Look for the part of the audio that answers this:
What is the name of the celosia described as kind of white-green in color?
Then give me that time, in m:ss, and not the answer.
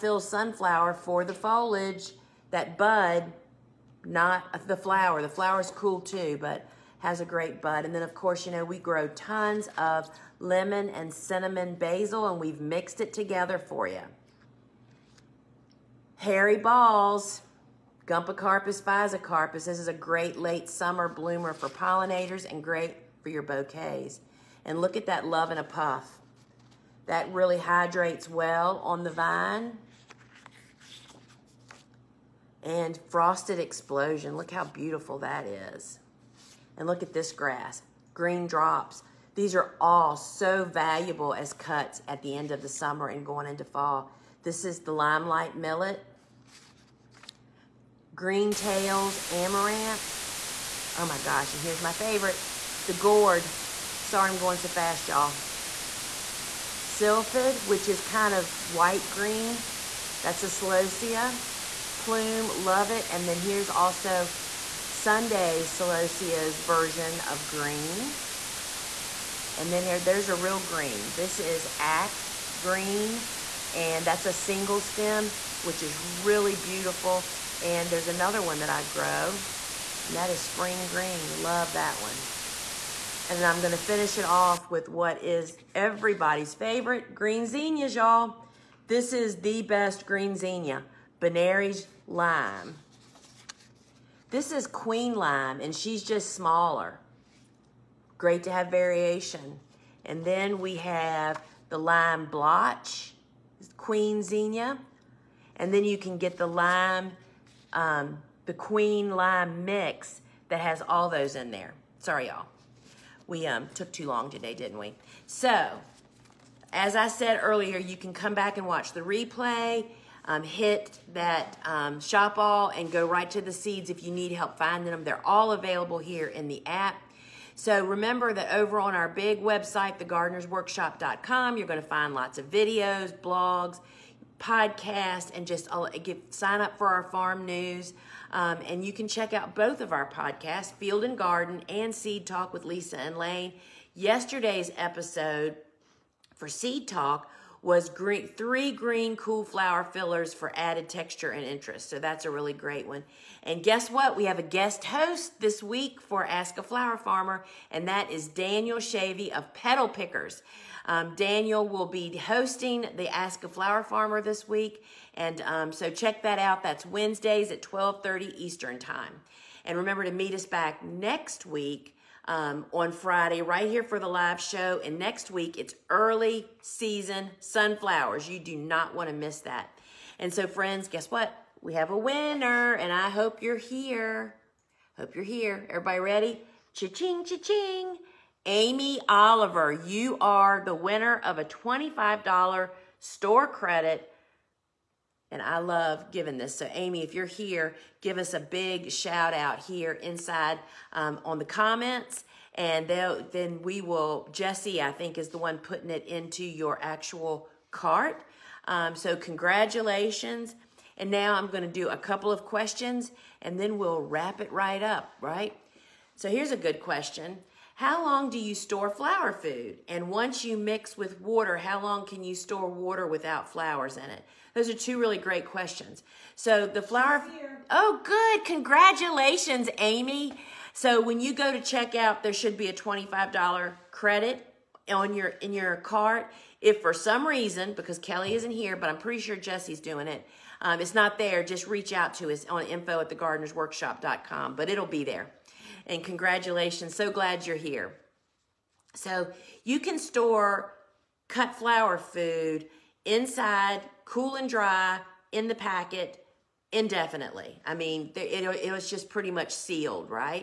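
0:56.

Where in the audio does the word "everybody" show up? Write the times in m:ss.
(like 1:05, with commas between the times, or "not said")
1:25, 3:05.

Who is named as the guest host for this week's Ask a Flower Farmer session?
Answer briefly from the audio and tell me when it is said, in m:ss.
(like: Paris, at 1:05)
Daniel Shavy, at 2:38.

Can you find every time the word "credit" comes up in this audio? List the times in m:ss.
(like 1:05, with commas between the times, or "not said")
3:13, 3:53.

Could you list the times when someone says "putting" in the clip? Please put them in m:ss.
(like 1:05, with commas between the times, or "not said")
3:25.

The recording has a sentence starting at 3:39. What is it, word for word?
And once you mix with water, how long can you store water without flowers in it?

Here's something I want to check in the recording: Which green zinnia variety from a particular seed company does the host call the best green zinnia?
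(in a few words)
Benary's Lime.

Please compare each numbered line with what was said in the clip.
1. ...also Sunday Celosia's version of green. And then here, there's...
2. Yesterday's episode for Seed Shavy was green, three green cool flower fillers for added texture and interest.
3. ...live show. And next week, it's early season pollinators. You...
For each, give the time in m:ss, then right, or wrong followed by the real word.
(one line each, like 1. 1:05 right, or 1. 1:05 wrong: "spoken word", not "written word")
1. 1:03 right
2. 2:23 wrong: "Talk", not "Shavy"
3. 2:54 wrong: "sunflowers", not "pollinators".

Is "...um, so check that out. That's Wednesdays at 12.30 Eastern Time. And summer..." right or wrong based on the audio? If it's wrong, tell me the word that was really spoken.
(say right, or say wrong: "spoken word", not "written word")
wrong: "remember", not "summer".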